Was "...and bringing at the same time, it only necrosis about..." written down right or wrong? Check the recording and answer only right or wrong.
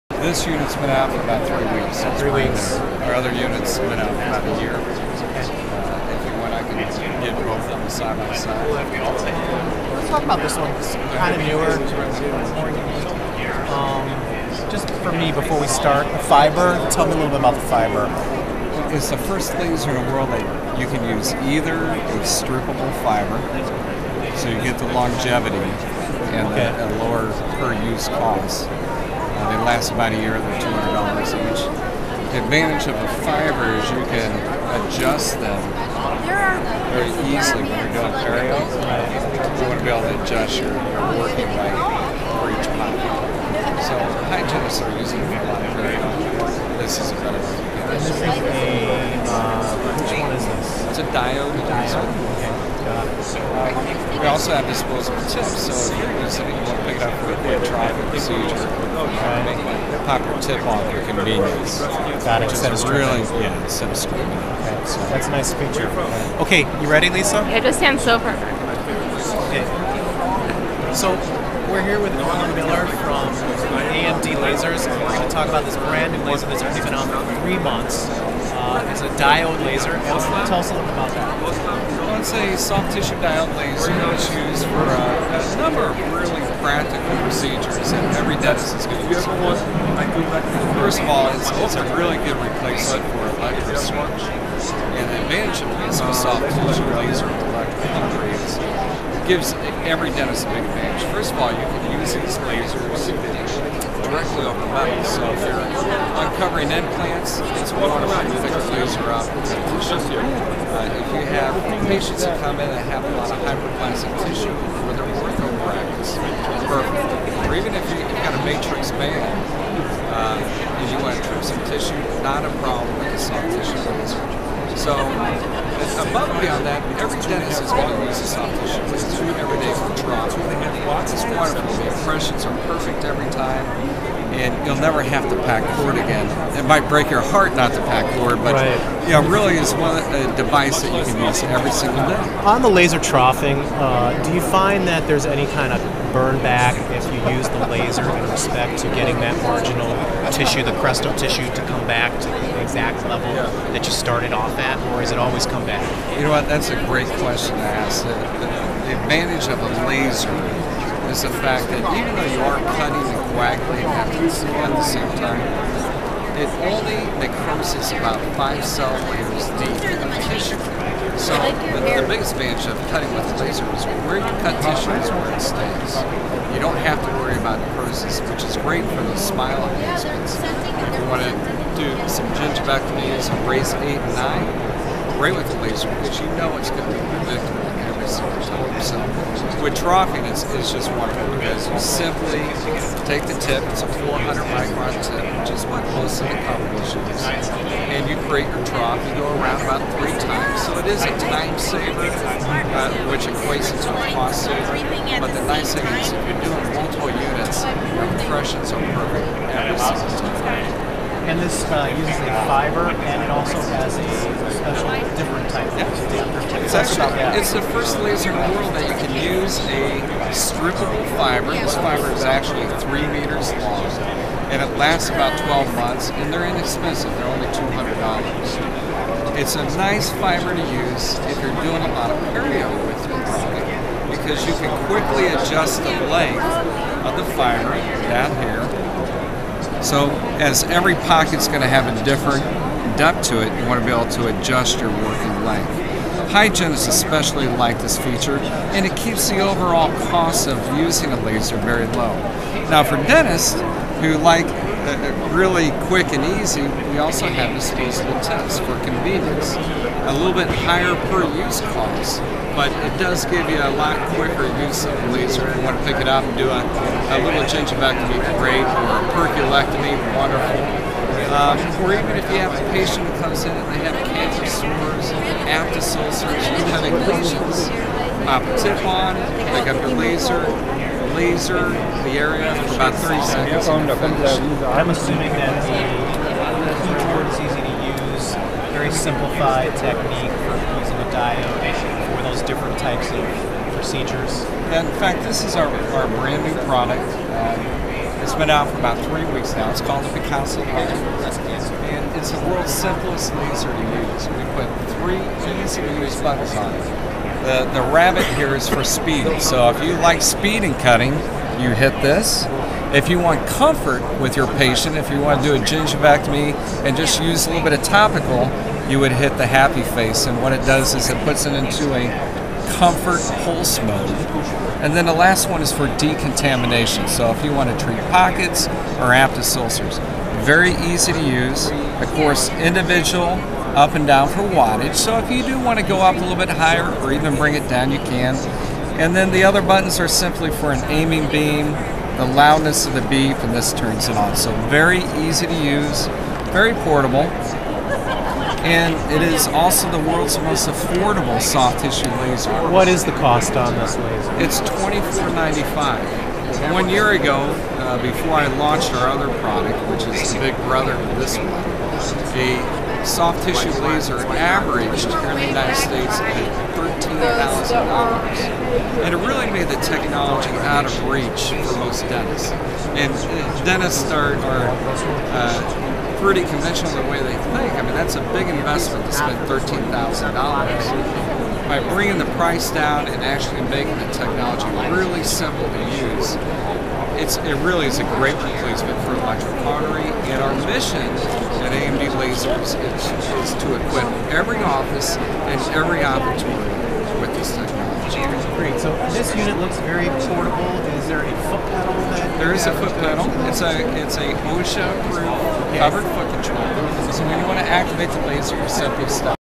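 wrong.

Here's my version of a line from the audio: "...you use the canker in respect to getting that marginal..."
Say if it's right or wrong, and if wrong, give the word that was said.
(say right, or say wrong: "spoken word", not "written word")
wrong: "laser", not "canker".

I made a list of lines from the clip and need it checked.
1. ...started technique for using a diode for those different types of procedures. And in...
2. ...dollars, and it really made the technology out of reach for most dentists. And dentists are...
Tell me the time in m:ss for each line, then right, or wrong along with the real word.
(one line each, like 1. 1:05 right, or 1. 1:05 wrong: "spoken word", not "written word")
1. 4:48 wrong: "simplified", not "started"
2. 6:07 right.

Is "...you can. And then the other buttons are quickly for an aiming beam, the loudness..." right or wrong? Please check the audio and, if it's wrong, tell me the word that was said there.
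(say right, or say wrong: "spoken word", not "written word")
wrong: "simply", not "quickly".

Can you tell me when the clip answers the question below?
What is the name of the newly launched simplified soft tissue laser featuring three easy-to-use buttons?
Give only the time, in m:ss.
5:00.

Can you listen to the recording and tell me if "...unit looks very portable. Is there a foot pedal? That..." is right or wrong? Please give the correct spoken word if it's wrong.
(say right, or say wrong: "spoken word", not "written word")
right.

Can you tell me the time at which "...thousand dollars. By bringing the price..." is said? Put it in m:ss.
6:19.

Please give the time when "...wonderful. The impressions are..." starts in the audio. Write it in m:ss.
2:11.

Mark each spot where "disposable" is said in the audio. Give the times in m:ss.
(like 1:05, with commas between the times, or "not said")
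0:54, 4:17.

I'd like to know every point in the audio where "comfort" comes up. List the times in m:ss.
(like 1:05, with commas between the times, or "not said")
5:13, 5:22.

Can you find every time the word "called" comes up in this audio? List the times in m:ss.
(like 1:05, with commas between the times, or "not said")
4:59.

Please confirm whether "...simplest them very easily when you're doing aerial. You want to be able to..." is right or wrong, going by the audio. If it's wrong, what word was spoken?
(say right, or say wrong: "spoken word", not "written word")
wrong: "adjust", not "simplest".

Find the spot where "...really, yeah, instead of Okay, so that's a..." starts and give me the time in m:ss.
1:02.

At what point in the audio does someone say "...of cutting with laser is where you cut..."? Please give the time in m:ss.
2:52.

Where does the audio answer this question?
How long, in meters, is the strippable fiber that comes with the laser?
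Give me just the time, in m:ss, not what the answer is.
3:42.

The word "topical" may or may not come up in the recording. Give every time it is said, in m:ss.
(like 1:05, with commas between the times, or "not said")
5:17.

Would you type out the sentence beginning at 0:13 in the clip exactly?
Um, just for me, before we start, the fiber.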